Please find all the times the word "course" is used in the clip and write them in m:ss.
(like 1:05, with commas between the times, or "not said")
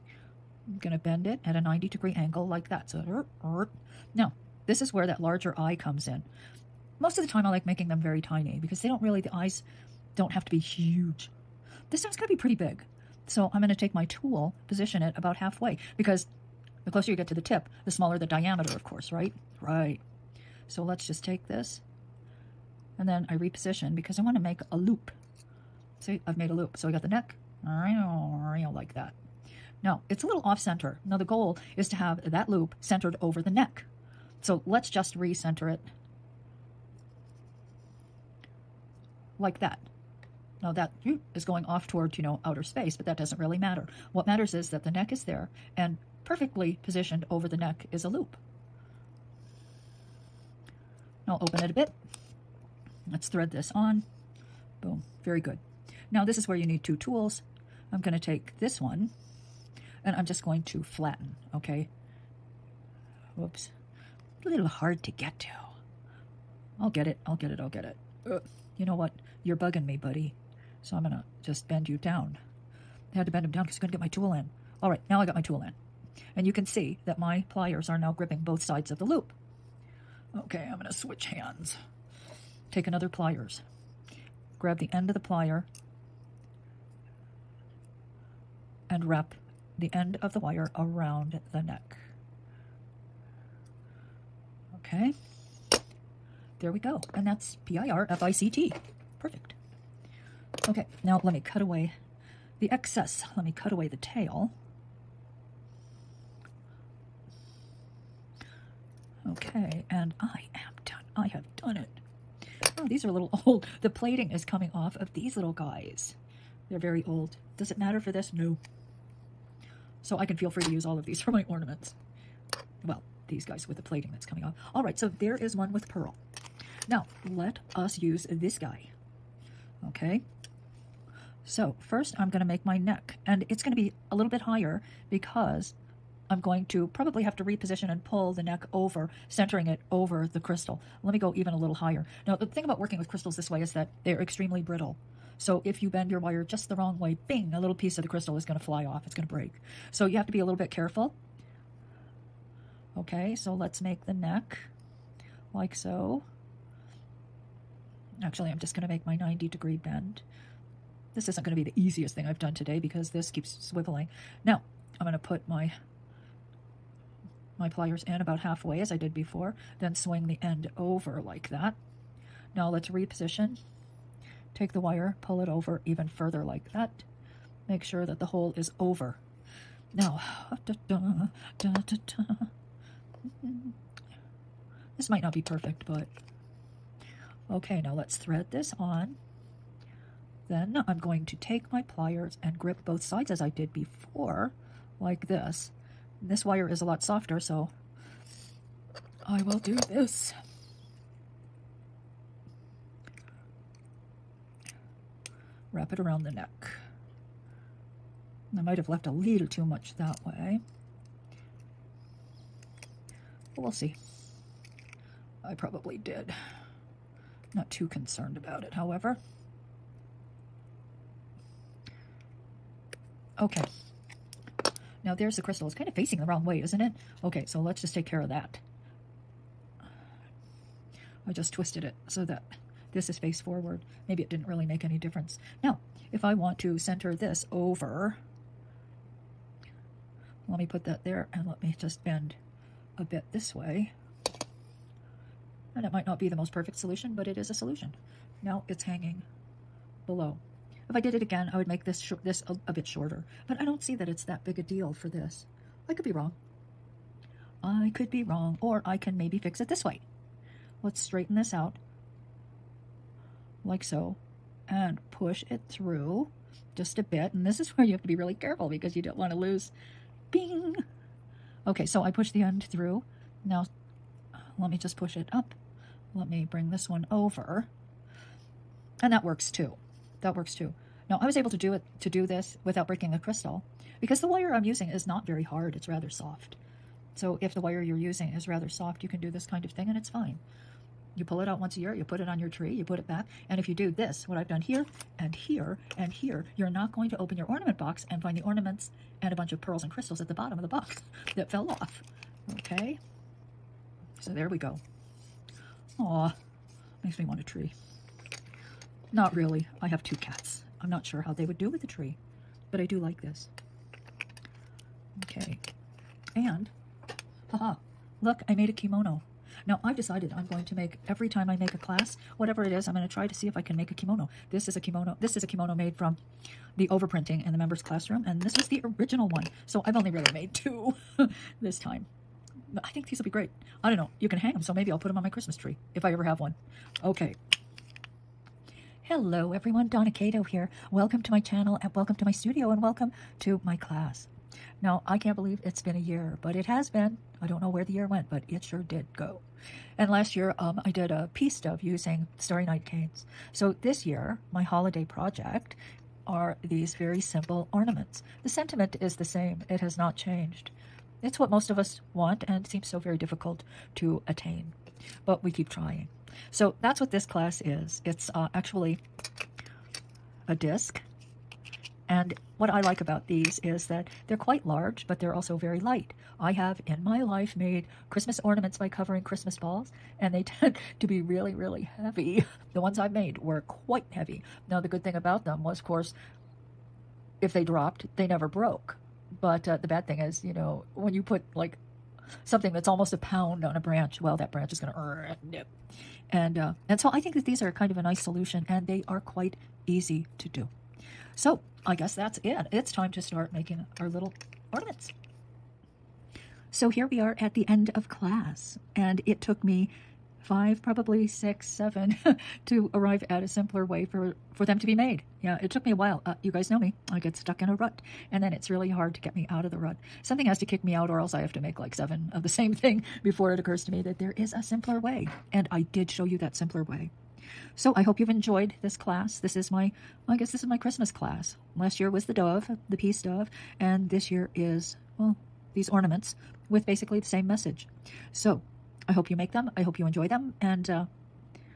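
0:18, 6:25.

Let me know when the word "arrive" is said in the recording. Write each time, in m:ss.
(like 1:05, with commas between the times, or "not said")
6:52.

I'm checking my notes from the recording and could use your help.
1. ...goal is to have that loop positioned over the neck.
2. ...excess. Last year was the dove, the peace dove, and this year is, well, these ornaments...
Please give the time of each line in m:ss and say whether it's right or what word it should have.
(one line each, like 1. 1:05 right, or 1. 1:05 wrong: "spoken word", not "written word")
1. 0:31 wrong: "centered", not "positioned"
2. 7:11 wrong: "class", not "excess".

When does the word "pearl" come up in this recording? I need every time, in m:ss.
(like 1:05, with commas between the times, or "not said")
2:05, 4:59.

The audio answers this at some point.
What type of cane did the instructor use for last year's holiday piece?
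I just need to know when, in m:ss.
5:52.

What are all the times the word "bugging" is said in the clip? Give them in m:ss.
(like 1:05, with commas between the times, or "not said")
1:09.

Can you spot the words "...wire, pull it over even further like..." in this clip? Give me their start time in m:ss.
2:54.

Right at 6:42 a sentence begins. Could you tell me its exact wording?
It's time to start making our little ornaments.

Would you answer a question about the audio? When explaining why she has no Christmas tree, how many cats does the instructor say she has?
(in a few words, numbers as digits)
2.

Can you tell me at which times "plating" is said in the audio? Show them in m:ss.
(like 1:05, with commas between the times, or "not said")
1:53, 2:03.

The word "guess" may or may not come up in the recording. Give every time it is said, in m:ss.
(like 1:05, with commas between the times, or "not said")
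6:41, 7:10.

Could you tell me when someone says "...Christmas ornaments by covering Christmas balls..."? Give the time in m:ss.
6:18.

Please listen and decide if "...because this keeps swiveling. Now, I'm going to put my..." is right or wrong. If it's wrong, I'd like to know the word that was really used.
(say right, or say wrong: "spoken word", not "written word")
right.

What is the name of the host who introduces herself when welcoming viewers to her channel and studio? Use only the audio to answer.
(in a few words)
Donna Kato.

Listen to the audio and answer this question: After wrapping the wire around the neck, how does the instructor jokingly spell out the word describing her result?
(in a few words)
P-I-R-F-I-C-T.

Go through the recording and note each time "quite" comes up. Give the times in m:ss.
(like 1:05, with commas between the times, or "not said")
6:14, 6:23, 6:39.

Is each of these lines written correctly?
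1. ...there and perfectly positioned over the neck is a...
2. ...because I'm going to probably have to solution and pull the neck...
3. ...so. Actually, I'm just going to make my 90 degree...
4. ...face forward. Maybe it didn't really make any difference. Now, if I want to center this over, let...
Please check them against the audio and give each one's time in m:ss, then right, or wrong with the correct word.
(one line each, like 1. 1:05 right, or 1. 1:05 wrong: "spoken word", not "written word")
1. 0:45 right
2. 2:15 wrong: "reposition", not "solution"
3. 2:35 right
4. 3:53 right.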